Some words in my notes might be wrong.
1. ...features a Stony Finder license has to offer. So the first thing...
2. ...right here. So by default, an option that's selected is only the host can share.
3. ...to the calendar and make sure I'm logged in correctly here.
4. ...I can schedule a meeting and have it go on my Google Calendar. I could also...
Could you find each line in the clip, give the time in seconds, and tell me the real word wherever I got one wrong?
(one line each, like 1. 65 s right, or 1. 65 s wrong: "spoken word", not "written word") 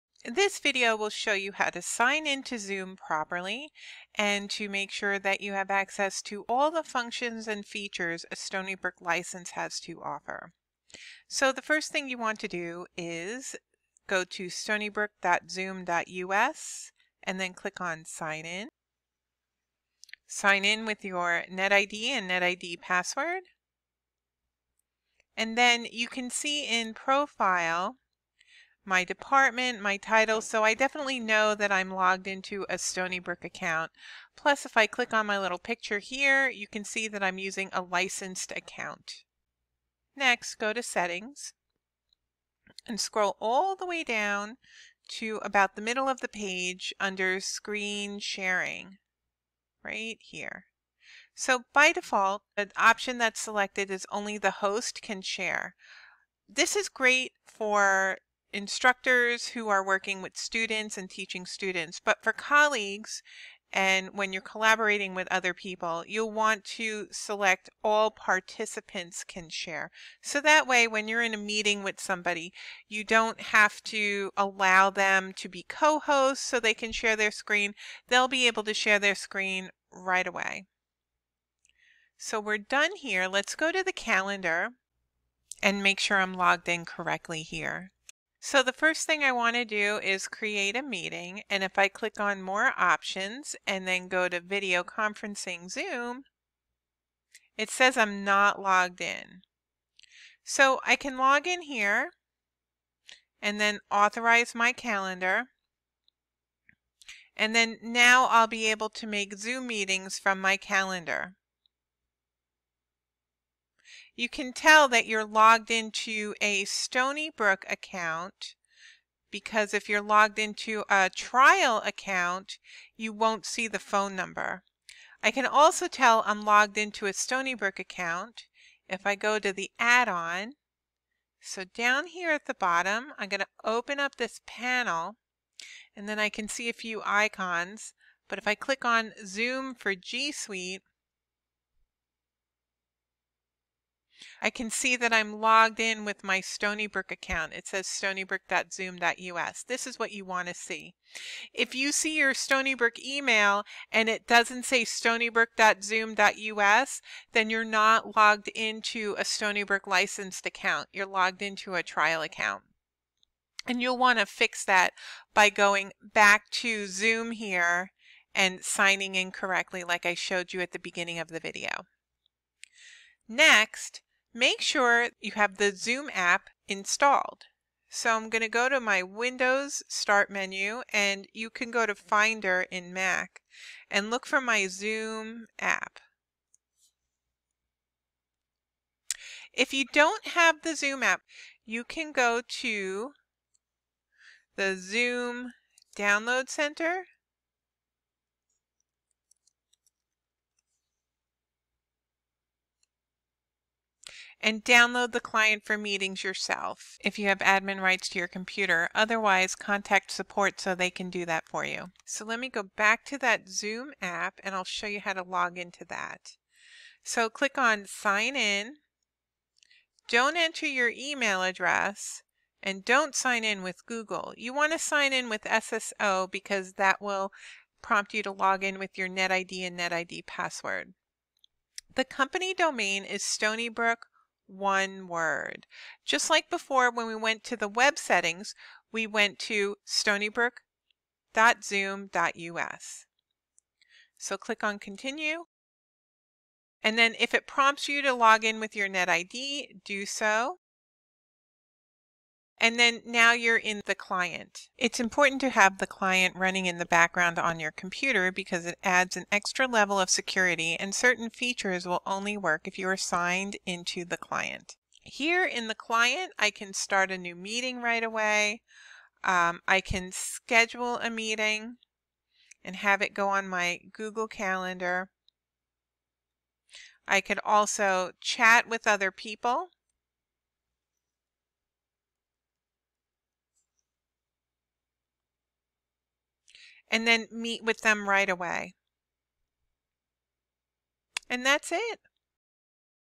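1. 7 s wrong: "Brook", not "Finder"
2. 49 s right
3. 83 s right
4. 269 s right.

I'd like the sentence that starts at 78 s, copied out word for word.
They'll be able to share their screen right away.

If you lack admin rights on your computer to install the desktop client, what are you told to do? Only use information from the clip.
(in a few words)
Contact support.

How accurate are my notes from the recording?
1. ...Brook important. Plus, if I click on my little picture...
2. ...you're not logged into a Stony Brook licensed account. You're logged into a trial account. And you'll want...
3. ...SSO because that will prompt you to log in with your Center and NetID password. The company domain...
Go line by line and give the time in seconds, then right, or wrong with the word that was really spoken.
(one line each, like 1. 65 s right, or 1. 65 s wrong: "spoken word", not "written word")
1. 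33 s wrong: "account", not "important"
2. 157 s right
3. 225 s wrong: "NetID", not "Center".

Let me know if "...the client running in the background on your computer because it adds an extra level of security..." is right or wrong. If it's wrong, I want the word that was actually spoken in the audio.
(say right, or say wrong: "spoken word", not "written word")
right.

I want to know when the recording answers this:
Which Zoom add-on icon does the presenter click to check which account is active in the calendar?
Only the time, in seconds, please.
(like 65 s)
139 s.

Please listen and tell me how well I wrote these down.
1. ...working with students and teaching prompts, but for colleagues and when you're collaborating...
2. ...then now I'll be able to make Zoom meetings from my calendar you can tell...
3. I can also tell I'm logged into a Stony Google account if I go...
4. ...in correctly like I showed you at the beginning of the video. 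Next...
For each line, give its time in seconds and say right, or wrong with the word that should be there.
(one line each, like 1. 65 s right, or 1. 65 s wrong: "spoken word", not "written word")
1. 59 s wrong: "students", not "prompts"
2. 107 s right
3. 125 s wrong: "Brook", not "Google"
4. 169 s right.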